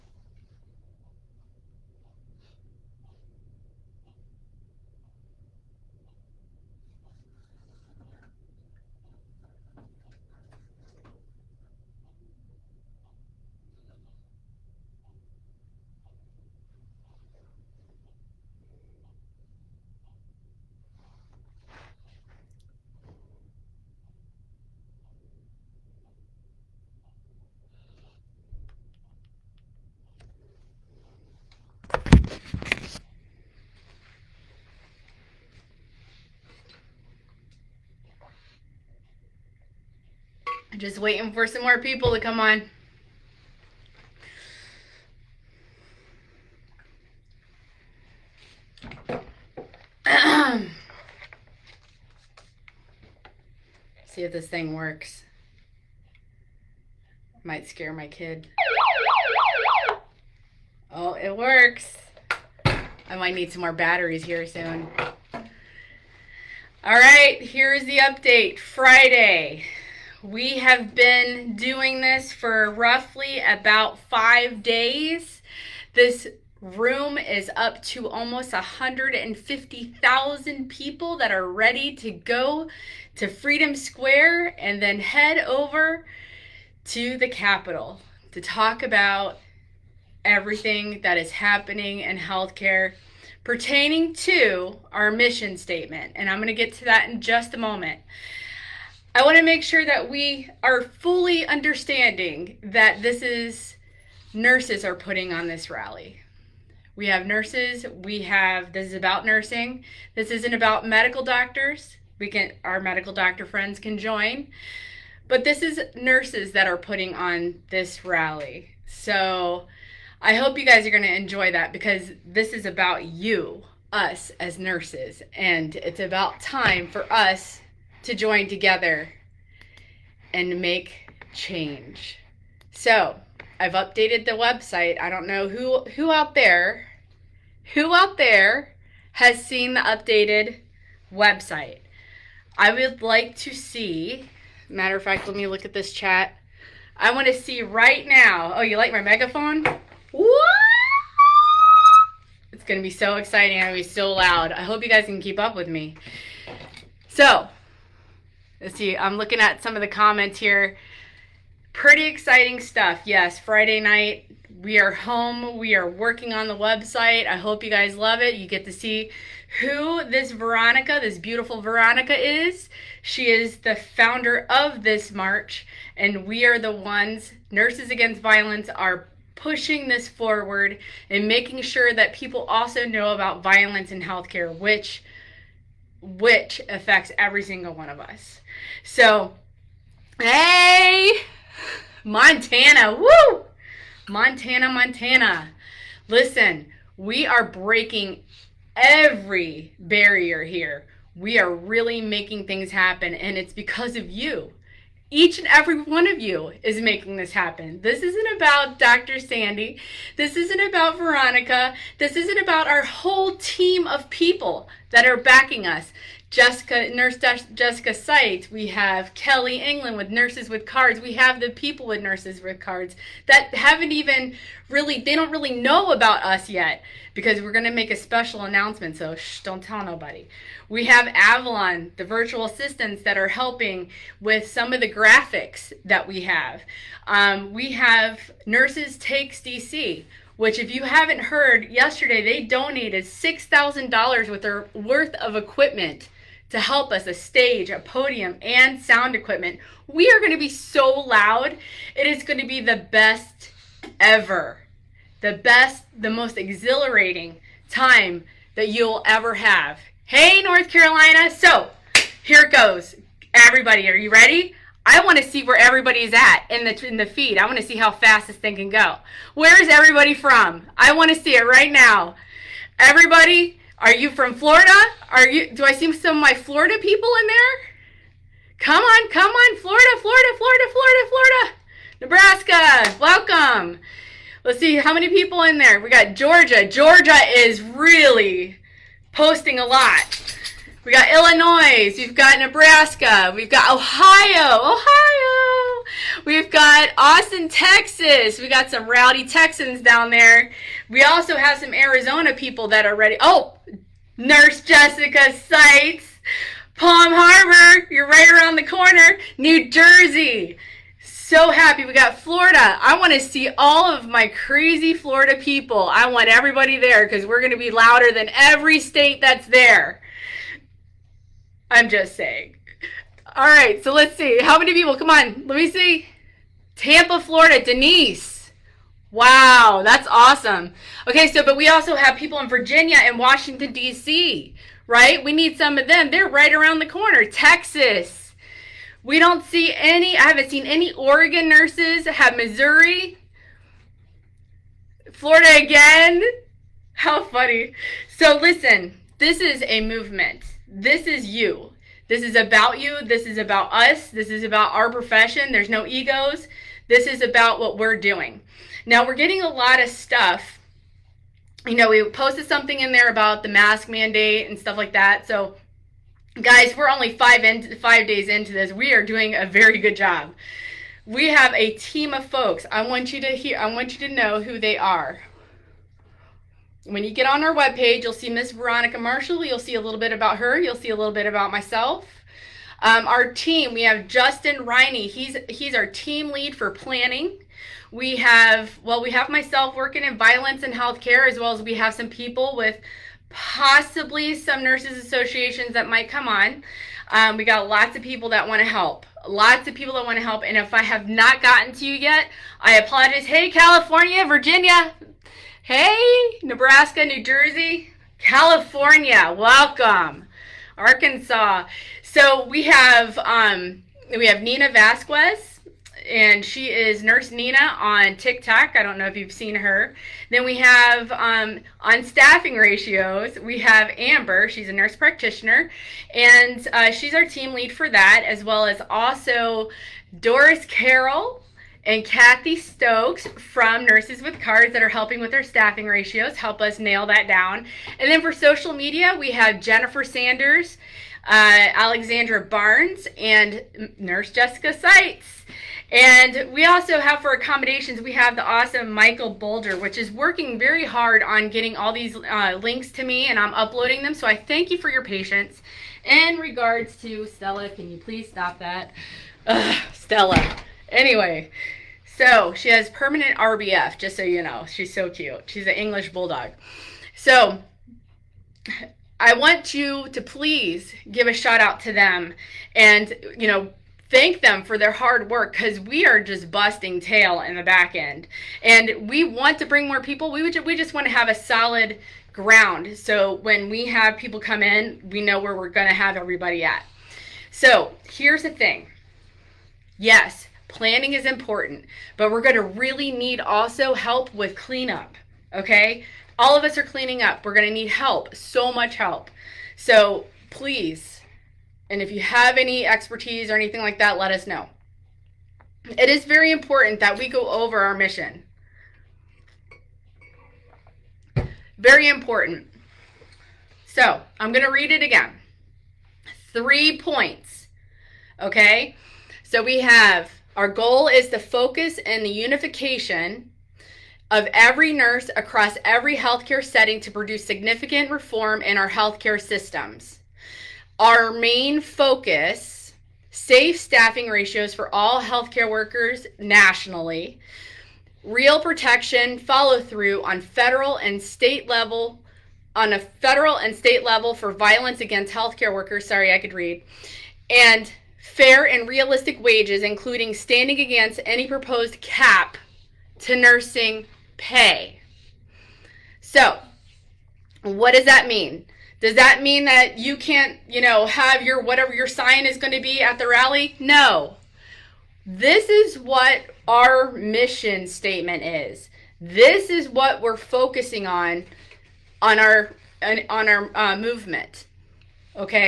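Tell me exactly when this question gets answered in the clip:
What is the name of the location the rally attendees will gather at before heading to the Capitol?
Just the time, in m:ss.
1:23.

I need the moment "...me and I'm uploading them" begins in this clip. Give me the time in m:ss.
7:33.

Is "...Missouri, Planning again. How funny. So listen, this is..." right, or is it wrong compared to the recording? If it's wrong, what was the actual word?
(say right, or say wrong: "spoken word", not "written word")
wrong: "Florida", not "Planning".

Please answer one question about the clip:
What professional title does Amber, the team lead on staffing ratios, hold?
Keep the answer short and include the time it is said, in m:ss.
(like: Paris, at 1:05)
nurse practitioner, at 7:04.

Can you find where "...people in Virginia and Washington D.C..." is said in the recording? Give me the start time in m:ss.
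5:32.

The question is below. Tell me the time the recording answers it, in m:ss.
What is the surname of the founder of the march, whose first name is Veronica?
6:18.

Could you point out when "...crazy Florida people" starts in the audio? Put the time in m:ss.
5:14.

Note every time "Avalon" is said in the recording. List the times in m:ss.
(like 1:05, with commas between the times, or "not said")
3:51.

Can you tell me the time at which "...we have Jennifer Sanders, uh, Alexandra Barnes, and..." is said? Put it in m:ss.
7:19.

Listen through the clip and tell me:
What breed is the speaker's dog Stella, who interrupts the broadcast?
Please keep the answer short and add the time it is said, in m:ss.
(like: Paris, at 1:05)
English bulldog, at 7:45.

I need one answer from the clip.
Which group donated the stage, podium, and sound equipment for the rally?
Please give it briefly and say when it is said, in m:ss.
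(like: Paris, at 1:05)
Nurses Takes DC, at 3:58.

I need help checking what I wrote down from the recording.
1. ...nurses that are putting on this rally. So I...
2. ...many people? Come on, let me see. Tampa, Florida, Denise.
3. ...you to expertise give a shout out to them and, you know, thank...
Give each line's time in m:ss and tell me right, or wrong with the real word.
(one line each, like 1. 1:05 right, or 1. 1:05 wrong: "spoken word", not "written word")
1. 1:55 right
2. 5:24 right
3. 7:49 wrong: "please", not "expertise".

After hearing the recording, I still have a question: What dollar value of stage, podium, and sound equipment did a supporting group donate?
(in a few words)
$6000.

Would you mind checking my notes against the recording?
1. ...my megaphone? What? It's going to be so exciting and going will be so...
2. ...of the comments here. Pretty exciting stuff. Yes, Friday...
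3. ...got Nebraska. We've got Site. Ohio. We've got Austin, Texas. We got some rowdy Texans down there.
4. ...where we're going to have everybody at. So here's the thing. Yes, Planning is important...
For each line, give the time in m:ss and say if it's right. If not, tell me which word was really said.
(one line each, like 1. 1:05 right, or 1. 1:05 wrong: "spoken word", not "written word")
1. 2:28 right
2. 2:39 right
3. 4:52 wrong: "Ohio", not "Site"
4. 8:05 right.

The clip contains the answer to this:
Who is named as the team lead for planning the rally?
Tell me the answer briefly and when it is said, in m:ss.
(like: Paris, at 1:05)
Justin Riney, at 6:24.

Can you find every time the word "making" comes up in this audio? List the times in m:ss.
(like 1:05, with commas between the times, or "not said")
3:01, 3:21, 3:26.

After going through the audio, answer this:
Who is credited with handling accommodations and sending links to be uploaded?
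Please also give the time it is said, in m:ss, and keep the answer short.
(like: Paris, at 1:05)
Michael Boulder, at 7:28.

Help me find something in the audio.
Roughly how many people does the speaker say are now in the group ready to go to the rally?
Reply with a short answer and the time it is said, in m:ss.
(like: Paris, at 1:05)
150,000, at 1:18.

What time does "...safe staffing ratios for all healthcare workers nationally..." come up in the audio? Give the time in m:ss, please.
8:53.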